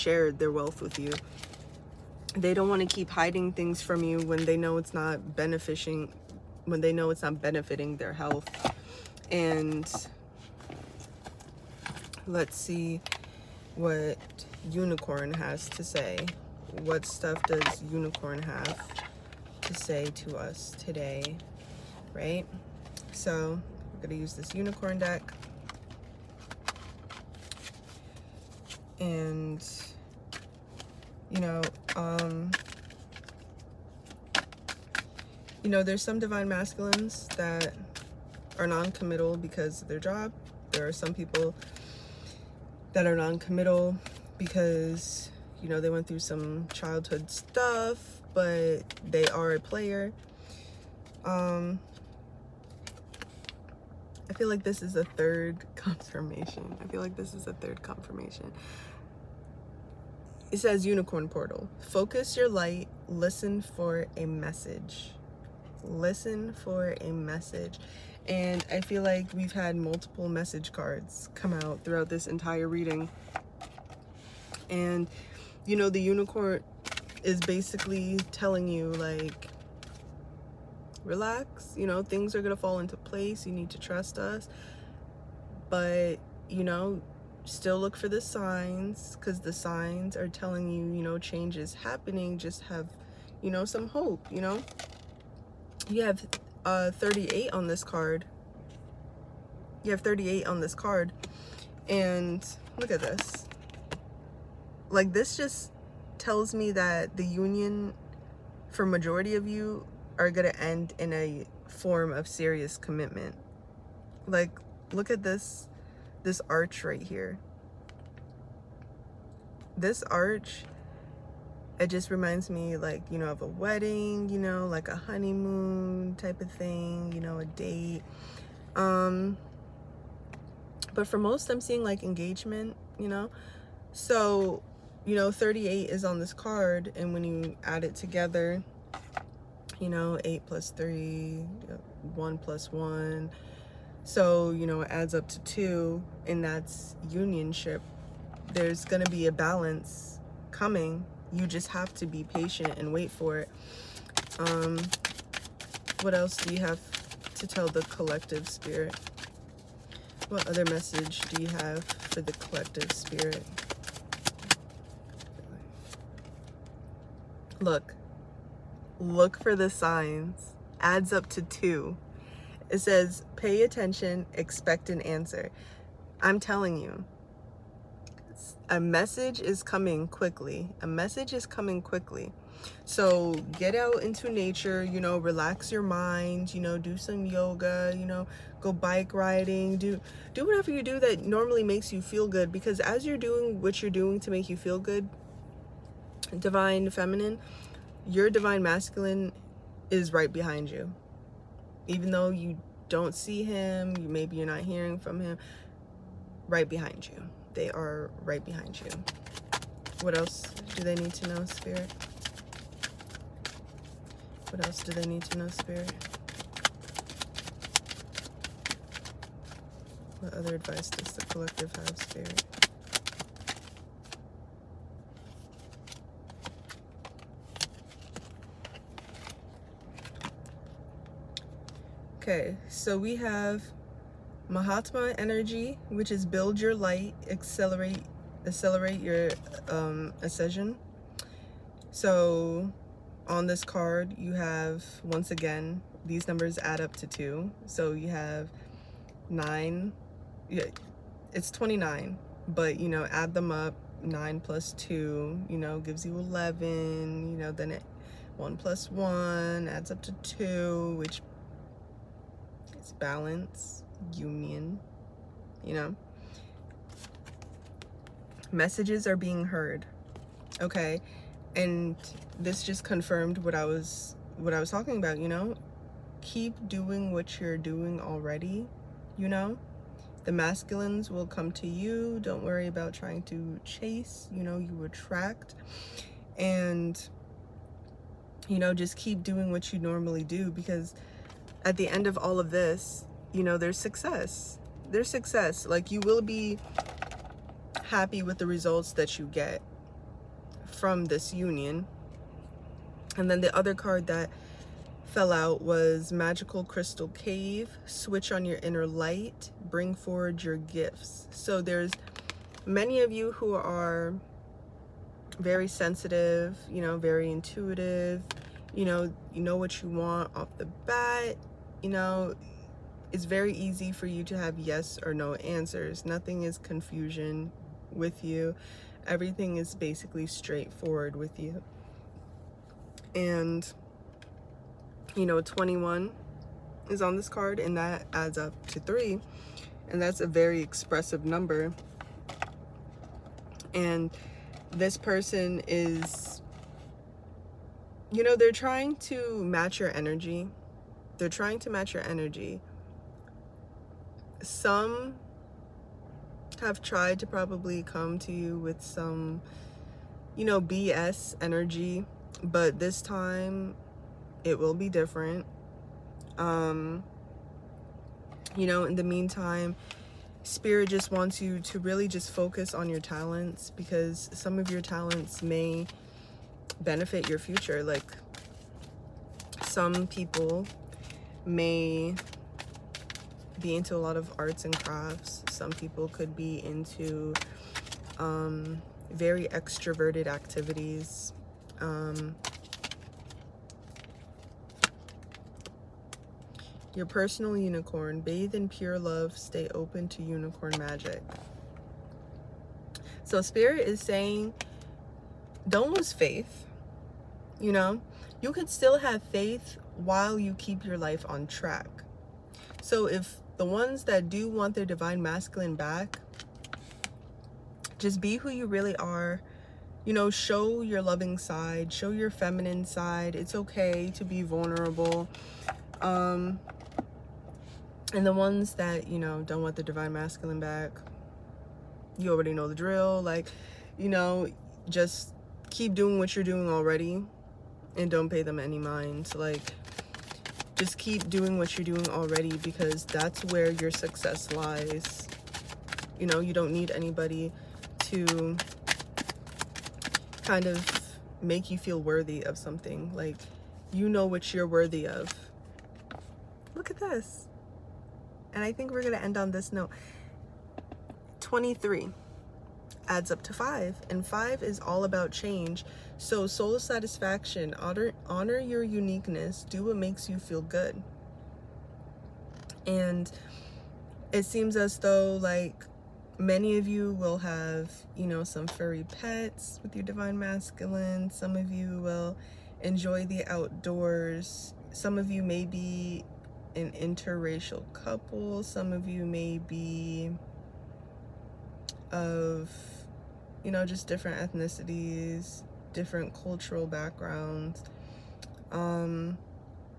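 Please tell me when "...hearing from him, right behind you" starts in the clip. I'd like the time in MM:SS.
03:24.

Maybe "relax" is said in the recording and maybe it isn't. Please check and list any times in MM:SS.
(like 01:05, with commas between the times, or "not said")
01:21, 03:05.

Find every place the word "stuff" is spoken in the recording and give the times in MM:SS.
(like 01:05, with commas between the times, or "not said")
00:17, 00:47.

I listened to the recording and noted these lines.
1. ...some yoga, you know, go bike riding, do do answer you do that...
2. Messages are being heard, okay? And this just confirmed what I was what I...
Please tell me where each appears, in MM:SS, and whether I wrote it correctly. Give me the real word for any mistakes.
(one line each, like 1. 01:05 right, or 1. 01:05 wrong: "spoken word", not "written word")
1. 03:06 wrong: "whatever", not "answer"
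2. 04:28 right.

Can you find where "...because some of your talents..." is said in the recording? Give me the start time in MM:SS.
06:13.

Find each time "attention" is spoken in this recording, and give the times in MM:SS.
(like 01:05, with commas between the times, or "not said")
02:53.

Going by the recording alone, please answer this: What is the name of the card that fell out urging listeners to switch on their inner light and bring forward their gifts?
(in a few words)
Magical Crystal Cave.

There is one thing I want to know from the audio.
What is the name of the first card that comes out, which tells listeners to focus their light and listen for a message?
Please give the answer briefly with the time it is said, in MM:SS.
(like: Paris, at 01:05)
Unicorn portal, at 01:00.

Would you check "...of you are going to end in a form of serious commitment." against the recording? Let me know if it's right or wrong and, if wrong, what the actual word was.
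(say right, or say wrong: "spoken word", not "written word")
right.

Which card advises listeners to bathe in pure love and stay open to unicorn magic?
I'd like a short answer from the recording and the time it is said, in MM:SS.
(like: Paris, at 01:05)
Your personal unicorn, at 06:36.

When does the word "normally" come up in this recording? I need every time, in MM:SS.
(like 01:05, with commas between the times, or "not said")
03:11, 04:49.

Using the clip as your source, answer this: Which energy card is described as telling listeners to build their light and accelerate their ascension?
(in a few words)
Mahatma energy.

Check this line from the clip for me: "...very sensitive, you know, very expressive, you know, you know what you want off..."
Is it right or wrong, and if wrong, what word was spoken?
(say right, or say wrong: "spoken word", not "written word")
wrong: "intuitive", not "expressive".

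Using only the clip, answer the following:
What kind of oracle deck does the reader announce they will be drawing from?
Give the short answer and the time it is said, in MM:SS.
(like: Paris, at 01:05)
Unicorn deck, at 00:24.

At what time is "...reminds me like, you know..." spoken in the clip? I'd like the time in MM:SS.
02:02.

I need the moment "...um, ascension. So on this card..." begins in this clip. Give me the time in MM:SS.
03:59.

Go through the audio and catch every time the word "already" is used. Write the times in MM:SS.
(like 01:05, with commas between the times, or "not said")
04:37, 07:12, 07:16, 07:22.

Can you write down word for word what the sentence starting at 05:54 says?
Some have tried to probably come to you with some, you know, BS energy, but this time it will be different.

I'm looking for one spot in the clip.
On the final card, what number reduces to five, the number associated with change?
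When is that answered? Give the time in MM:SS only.
07:41.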